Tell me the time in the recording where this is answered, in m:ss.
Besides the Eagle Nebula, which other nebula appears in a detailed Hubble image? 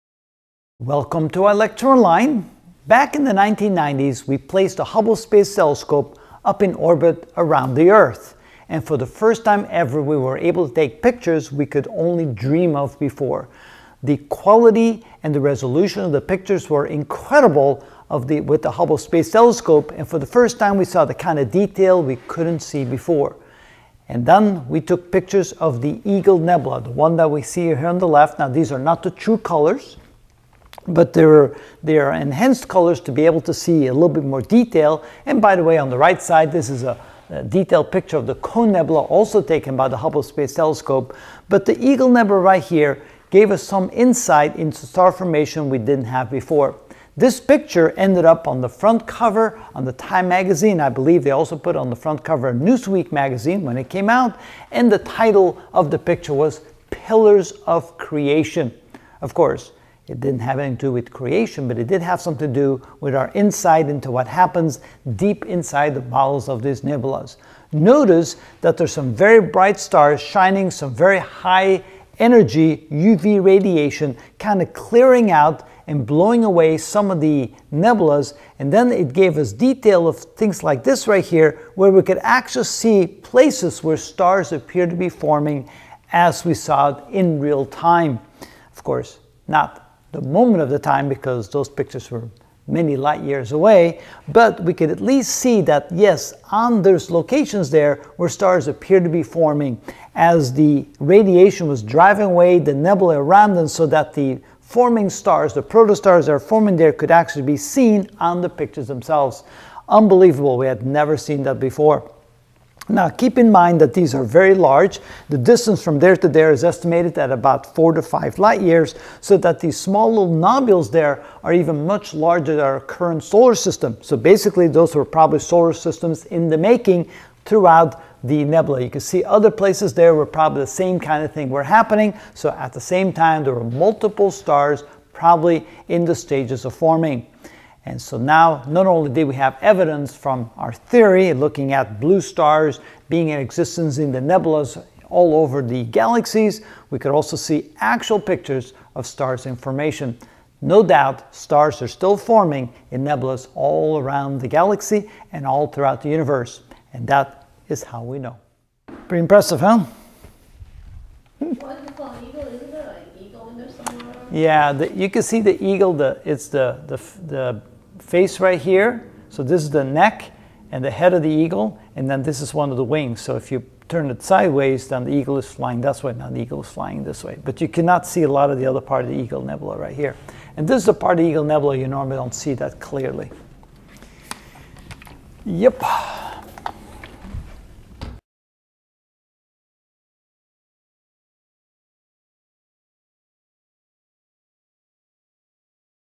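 0:38.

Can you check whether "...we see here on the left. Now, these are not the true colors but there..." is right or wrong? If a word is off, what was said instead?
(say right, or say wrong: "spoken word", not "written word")
right.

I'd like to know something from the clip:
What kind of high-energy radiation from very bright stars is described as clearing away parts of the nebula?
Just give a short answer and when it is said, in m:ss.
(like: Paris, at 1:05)
UV radiation, at 1:12.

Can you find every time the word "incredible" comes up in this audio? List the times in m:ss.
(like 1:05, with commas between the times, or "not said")
0:16.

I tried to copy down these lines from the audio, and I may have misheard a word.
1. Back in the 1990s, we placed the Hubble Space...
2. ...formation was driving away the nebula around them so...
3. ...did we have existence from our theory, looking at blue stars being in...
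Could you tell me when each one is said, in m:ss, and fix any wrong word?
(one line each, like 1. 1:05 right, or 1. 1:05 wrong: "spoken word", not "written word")
1. 0:02 right
2. 1:40 wrong: "radiation", not "formation"
3. 2:19 wrong: "evidence", not "existence".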